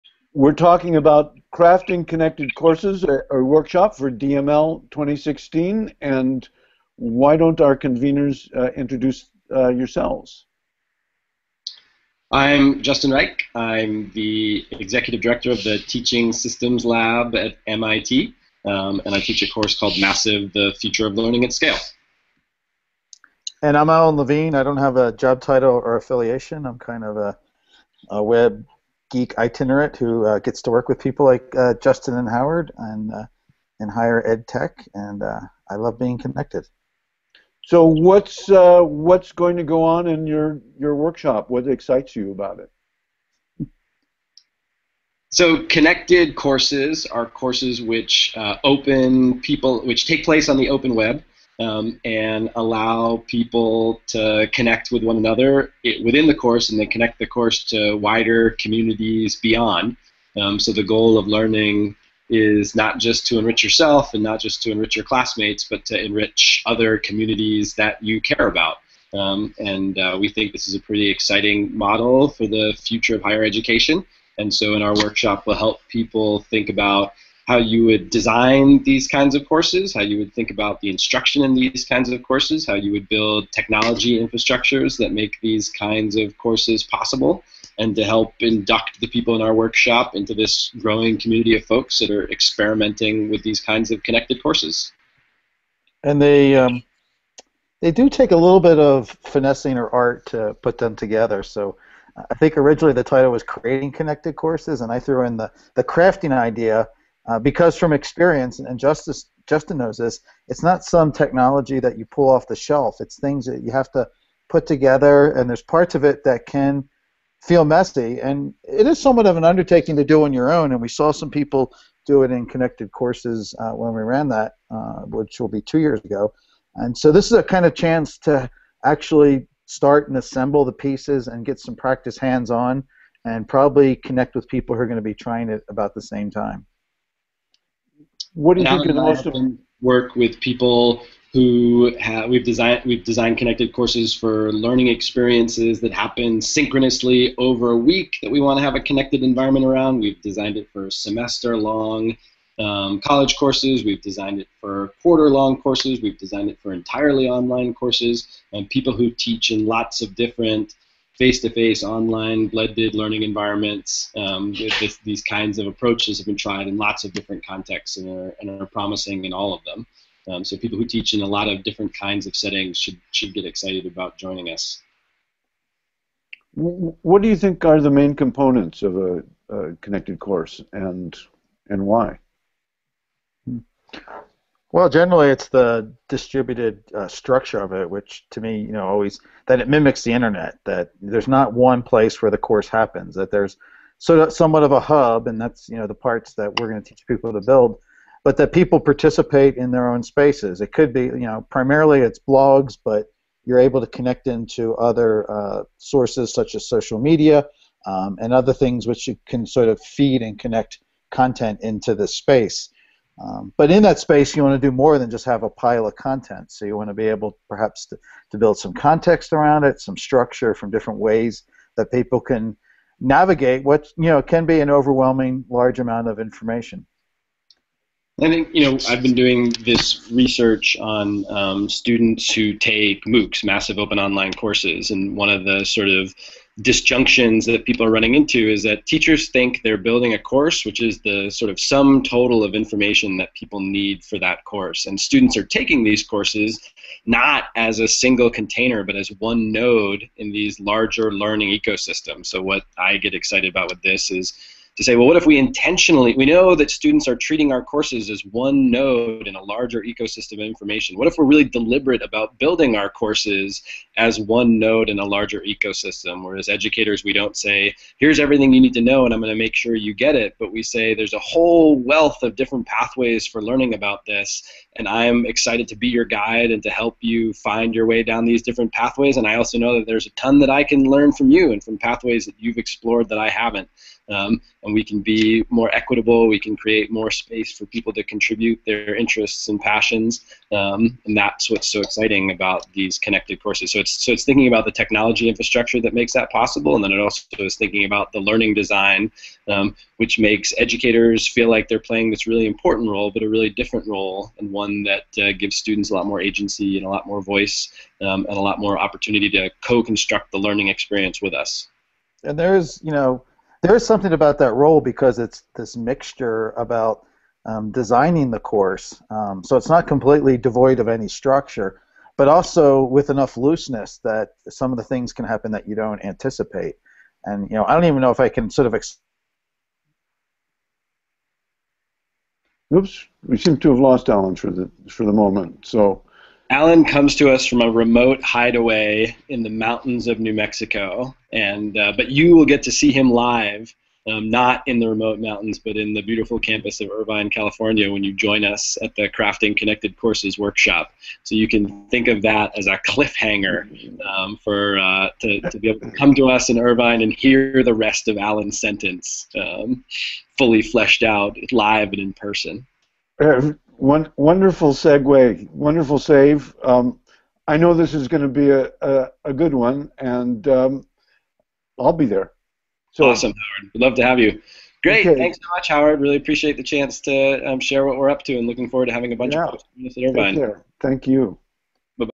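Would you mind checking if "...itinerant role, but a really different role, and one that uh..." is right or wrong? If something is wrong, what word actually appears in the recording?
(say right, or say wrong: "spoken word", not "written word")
wrong: "important", not "itinerant".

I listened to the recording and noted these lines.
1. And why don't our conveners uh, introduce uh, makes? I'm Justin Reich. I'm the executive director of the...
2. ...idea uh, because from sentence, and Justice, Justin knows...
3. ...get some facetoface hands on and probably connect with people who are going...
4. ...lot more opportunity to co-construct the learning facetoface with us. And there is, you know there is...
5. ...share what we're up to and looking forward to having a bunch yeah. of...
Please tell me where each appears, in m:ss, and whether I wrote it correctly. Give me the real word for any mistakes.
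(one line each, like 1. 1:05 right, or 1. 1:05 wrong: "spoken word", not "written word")
1. 0:05 wrong: "yourselves", not "makes"
2. 1:46 wrong: "experience", not "sentence"
3. 2:11 wrong: "practice", not "facetoface"
4. 5:08 wrong: "experience", not "facetoface"
5. 6:17 right.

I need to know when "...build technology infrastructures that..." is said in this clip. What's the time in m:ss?
1:23.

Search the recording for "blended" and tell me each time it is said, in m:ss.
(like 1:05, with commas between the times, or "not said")
2:42.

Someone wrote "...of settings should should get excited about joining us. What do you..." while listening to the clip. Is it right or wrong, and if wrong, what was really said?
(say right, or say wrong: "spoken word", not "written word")
right.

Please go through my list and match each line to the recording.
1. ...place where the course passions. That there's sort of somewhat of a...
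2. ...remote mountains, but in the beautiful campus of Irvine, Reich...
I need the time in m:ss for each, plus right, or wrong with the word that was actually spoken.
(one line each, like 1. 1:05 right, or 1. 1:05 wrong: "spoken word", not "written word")
1. 3:11 wrong: "happens", not "passions"
2. 5:44 wrong: "California", not "Reich".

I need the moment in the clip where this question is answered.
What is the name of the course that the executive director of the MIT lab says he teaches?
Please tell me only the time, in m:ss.
0:19.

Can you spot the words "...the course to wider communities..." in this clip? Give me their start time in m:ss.
0:57.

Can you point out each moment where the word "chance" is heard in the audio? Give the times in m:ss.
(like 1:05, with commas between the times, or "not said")
2:07, 6:16.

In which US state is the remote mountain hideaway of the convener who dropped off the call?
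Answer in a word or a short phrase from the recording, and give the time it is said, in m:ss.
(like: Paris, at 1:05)
New Mexico, at 5:40.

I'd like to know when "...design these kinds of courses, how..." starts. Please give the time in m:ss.
1:18.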